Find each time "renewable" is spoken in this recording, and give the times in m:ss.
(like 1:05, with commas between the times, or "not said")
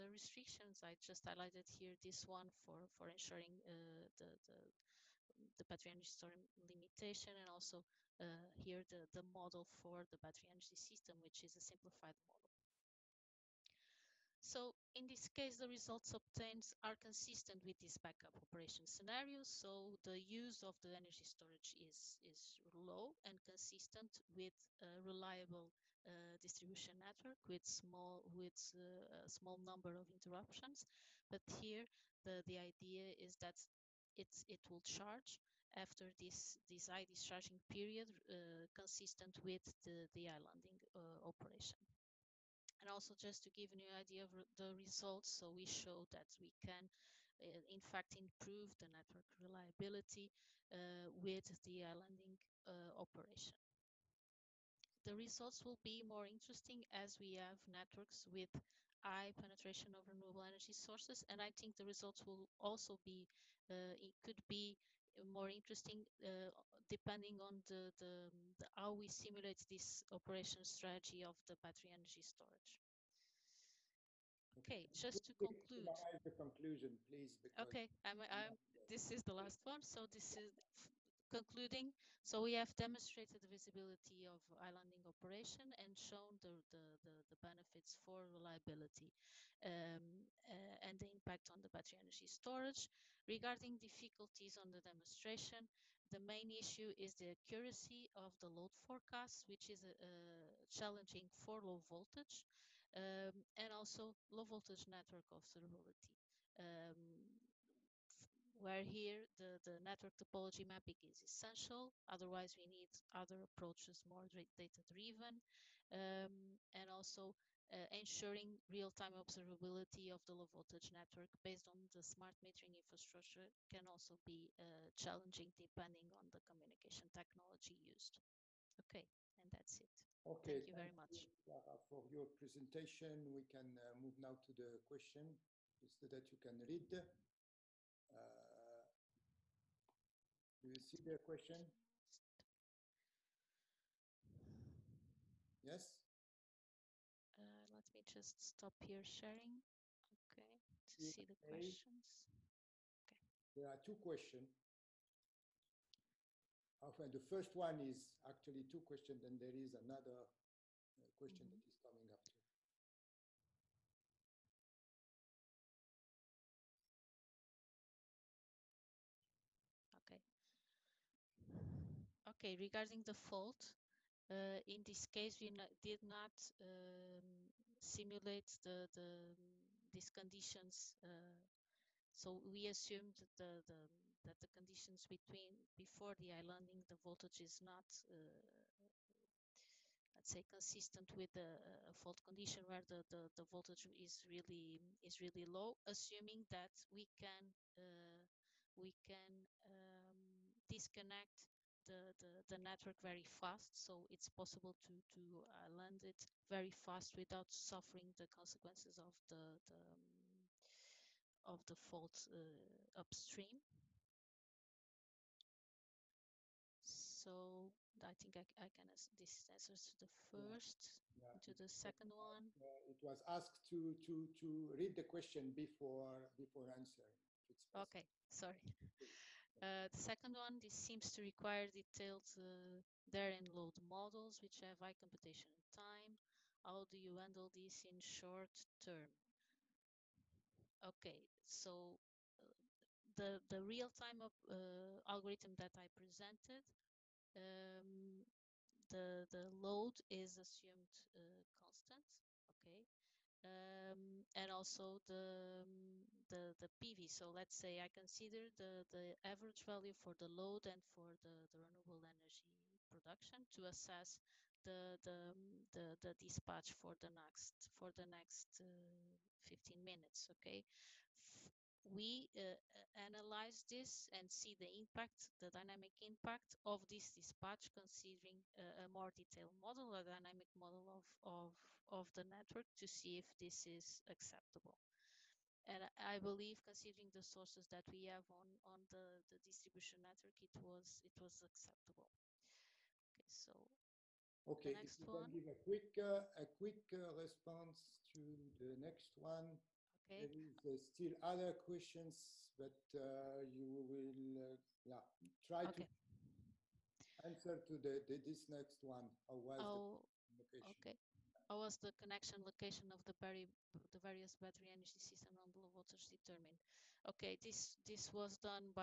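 1:00, 4:21.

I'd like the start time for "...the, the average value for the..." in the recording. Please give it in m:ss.
4:18.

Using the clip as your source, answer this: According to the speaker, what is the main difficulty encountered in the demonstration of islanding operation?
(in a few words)
Accuracy of the load forecast.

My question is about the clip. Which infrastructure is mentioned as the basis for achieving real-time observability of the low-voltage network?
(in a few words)
Smart metering infrastructure.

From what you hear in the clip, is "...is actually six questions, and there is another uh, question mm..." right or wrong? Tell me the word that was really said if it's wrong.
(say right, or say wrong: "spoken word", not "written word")
wrong: "two", not "six".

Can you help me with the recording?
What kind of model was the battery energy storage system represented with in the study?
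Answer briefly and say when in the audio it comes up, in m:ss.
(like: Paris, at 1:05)
A simplified model, at 0:11.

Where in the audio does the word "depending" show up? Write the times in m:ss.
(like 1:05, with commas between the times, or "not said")
1:06, 2:05.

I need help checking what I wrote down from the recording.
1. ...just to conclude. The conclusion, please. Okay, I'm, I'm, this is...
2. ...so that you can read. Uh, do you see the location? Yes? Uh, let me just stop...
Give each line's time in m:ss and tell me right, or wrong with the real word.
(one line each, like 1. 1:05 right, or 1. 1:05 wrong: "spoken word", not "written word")
1. 1:14 right
2. 2:15 wrong: "question", not "location".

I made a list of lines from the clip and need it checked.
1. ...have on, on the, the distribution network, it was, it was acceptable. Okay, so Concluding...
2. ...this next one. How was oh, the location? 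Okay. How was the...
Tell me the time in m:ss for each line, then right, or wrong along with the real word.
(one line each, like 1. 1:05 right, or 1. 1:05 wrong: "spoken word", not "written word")
1. 4:48 wrong: "Okay", not "Concluding"
2. 5:08 right.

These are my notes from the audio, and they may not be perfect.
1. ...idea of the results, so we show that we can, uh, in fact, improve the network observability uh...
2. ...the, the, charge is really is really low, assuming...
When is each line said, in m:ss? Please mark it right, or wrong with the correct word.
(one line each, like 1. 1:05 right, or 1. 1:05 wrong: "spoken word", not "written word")
1. 0:43 wrong: "reliability", not "observability"
2. 3:13 wrong: "voltage", not "charge".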